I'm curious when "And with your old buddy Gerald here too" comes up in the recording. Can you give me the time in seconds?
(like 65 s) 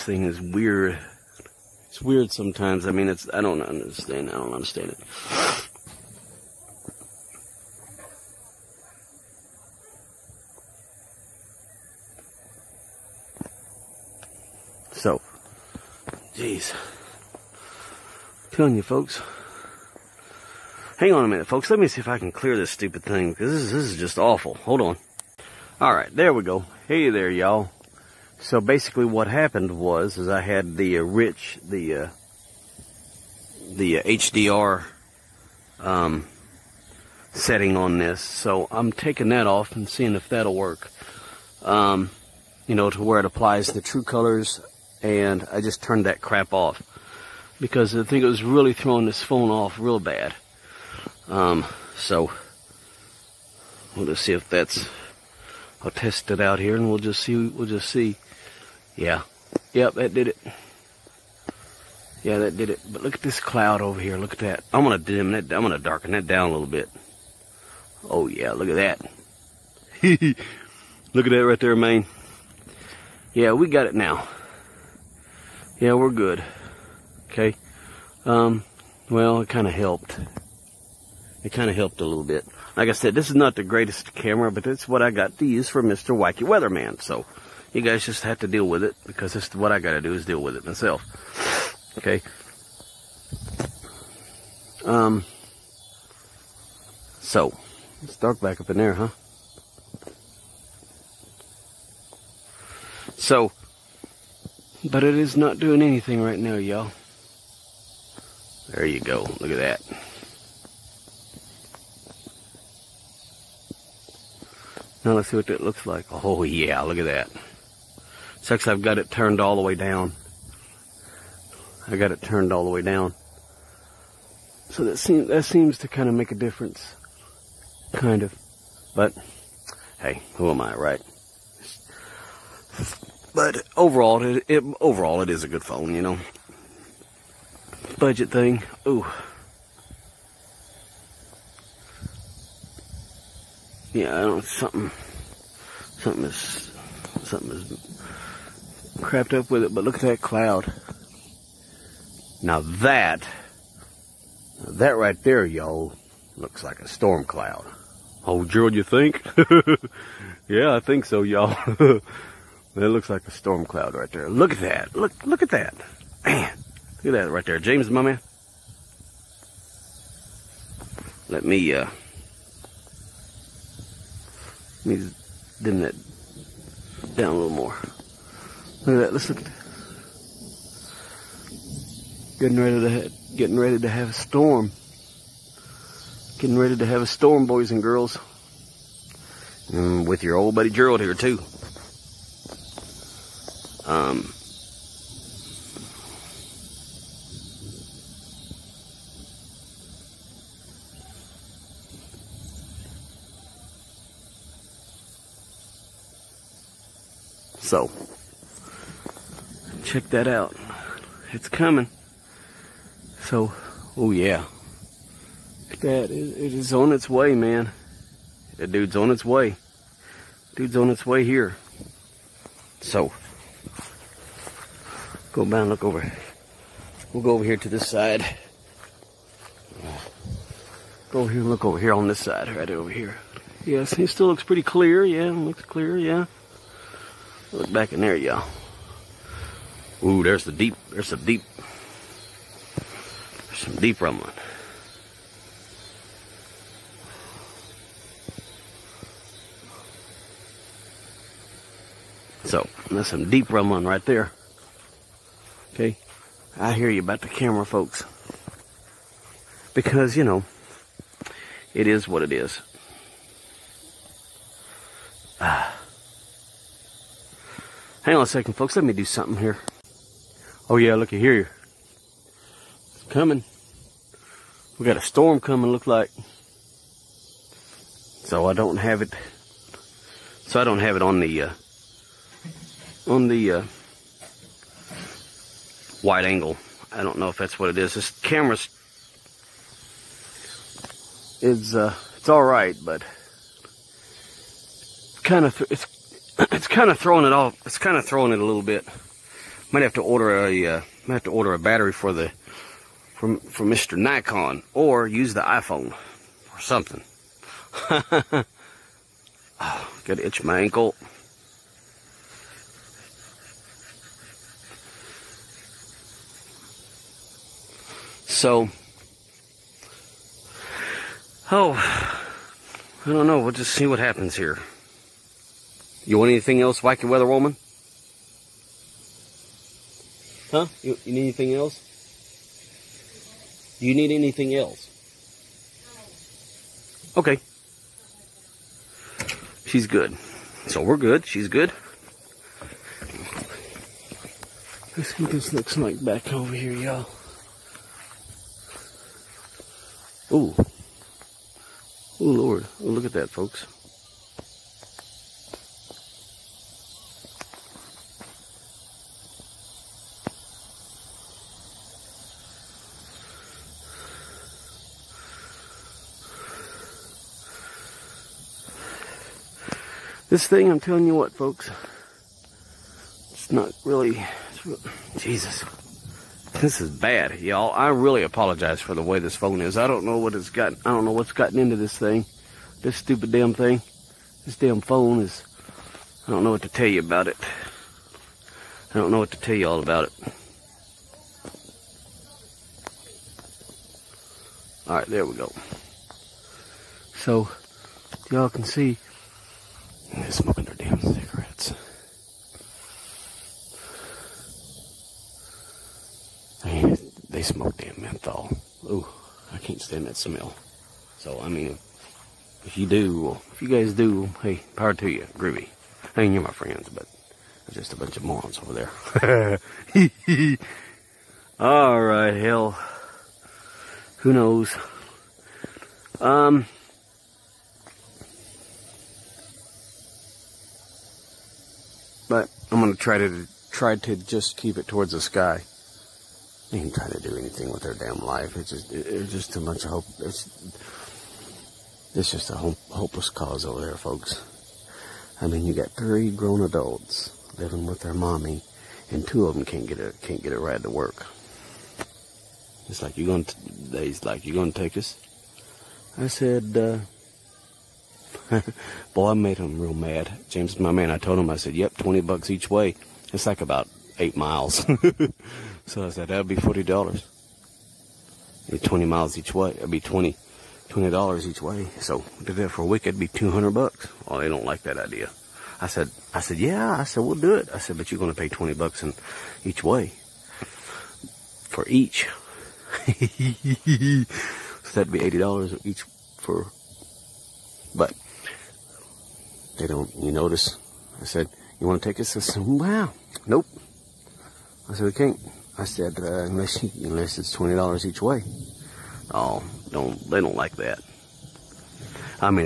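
189 s.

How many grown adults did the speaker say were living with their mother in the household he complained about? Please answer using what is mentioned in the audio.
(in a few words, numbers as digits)
3.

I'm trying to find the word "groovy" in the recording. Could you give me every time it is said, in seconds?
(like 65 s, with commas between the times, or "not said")
415 s.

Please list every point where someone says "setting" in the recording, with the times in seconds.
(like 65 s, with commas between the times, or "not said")
37 s.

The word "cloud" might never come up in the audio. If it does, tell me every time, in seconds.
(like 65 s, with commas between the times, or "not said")
63 s, 150 s, 157 s, 163 s.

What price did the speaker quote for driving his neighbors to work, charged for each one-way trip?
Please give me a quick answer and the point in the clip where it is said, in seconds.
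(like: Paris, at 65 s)
$20, at 461 s.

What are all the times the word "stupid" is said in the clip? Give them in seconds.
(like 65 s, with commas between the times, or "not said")
22 s, 382 s.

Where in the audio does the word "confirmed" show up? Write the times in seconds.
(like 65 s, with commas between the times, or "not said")
not said.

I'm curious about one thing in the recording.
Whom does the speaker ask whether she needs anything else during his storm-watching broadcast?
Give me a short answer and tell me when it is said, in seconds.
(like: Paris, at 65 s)
Wacky Weather Woman, at 326 s.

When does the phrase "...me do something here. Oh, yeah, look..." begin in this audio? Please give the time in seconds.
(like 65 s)
268 s.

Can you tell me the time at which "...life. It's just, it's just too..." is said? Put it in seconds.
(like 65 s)
438 s.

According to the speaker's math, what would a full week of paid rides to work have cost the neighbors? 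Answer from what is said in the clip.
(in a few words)
$200.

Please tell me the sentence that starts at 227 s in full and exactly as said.
We'll go over here to this side.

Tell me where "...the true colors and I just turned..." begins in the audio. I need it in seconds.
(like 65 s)
43 s.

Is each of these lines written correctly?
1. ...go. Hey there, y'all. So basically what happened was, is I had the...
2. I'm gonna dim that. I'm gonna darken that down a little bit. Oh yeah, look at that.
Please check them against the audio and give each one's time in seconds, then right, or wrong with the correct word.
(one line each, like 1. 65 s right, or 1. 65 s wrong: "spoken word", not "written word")
1. 26 s right
2. 64 s right.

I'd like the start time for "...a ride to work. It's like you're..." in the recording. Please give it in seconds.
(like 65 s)
450 s.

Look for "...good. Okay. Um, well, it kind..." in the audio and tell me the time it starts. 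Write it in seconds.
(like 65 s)
76 s.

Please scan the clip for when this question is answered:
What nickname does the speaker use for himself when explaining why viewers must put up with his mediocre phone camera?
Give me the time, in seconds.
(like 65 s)
85 s.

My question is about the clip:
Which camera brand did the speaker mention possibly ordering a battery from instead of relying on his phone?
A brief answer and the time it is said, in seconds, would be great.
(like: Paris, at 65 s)
Nikon, at 303 s.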